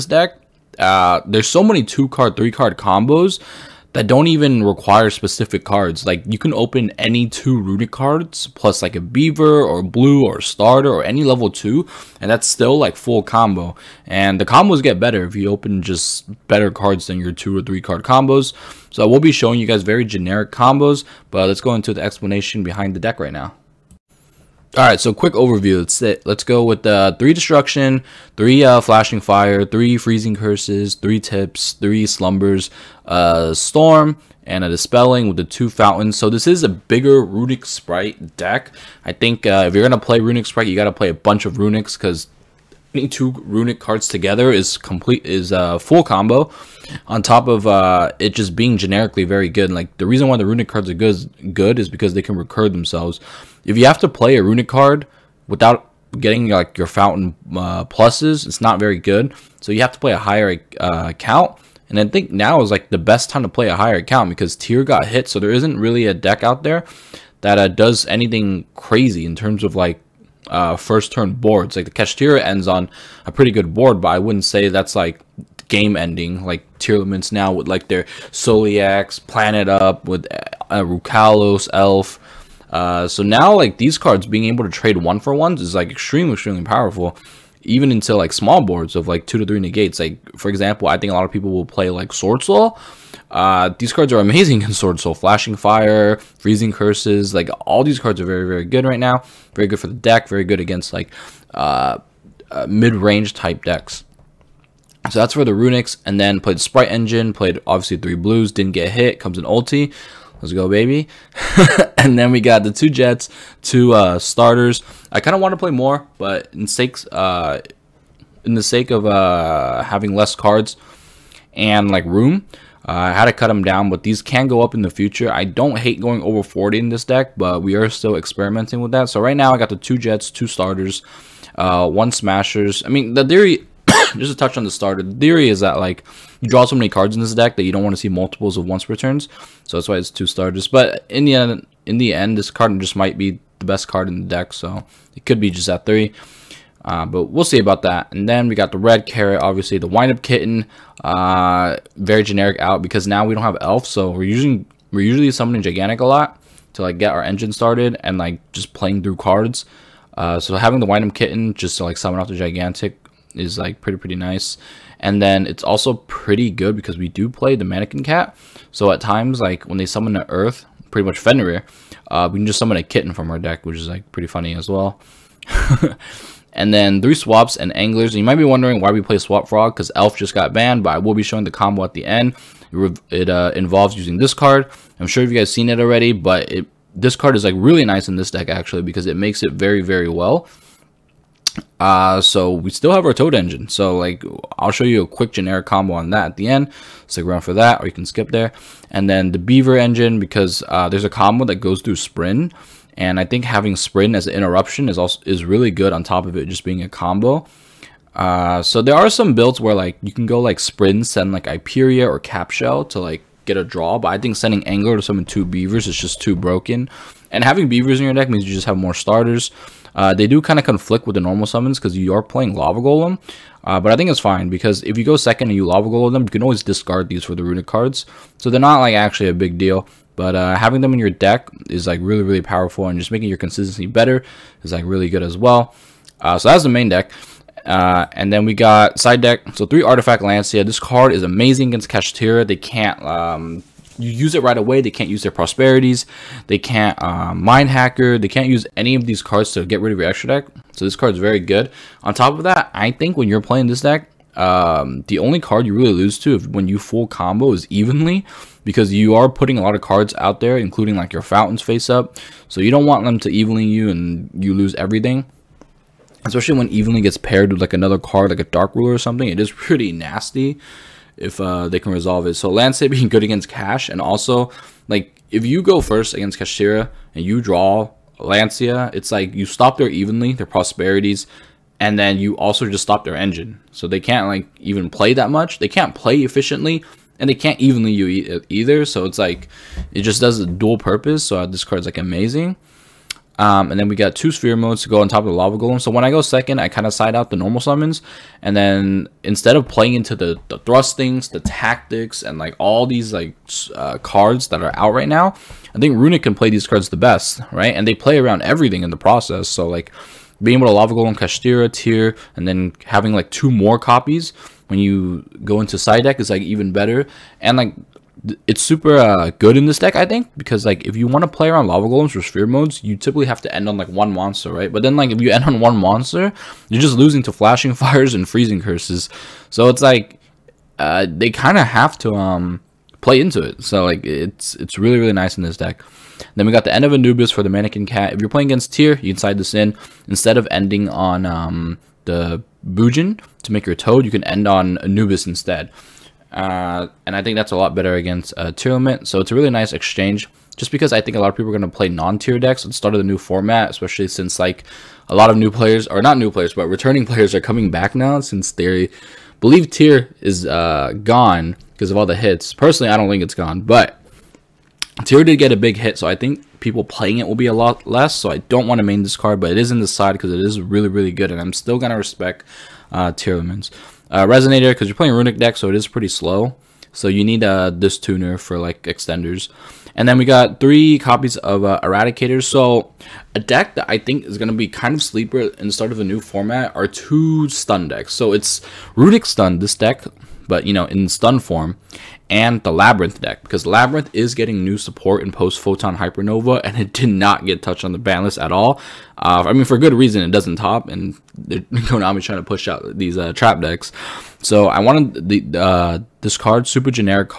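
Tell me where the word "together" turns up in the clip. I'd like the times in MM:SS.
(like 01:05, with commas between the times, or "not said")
00:44.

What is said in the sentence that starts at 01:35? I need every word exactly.
Flashing Fire, Freezing Curses, like all these cards are very, very good right now.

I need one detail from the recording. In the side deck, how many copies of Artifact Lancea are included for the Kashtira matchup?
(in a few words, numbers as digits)
3.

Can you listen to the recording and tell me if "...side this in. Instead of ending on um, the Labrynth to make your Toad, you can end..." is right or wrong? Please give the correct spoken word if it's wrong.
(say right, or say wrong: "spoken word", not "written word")
wrong: "Bujin", not "Labrynth".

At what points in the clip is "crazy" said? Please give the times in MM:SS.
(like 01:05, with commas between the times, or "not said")
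01:08.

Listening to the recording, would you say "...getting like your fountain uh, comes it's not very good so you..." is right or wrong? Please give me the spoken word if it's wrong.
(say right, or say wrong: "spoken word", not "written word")
wrong: "pluses", not "comes".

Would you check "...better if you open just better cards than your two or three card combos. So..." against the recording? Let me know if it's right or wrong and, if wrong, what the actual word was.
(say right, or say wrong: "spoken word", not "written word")
right.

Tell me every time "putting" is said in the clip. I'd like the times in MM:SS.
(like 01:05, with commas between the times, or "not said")
00:42, 04:19.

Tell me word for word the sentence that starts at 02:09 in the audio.
So right now I got the two Jets, two Starters, uh, one Smashers.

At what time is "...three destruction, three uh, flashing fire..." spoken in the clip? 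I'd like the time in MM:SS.
00:27.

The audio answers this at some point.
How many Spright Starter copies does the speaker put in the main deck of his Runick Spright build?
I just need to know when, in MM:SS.
02:19.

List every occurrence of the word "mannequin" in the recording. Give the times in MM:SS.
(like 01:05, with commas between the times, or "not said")
02:47, 05:37.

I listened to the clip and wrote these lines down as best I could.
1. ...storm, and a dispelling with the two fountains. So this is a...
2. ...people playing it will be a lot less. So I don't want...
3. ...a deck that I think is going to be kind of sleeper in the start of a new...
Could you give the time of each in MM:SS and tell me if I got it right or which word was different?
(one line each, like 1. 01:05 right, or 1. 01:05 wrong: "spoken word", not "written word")
1. 00:33 right
2. 06:06 right
3. 06:23 right.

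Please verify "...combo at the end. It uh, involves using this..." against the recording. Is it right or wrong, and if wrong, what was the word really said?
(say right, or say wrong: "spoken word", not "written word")
right.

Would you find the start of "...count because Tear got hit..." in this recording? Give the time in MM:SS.
01:04.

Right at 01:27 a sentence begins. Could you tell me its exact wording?
Even into like small boards of like two to three negates.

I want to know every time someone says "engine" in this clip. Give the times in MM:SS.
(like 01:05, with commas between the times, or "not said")
01:46, 02:37, 03:13, 03:19, 04:43.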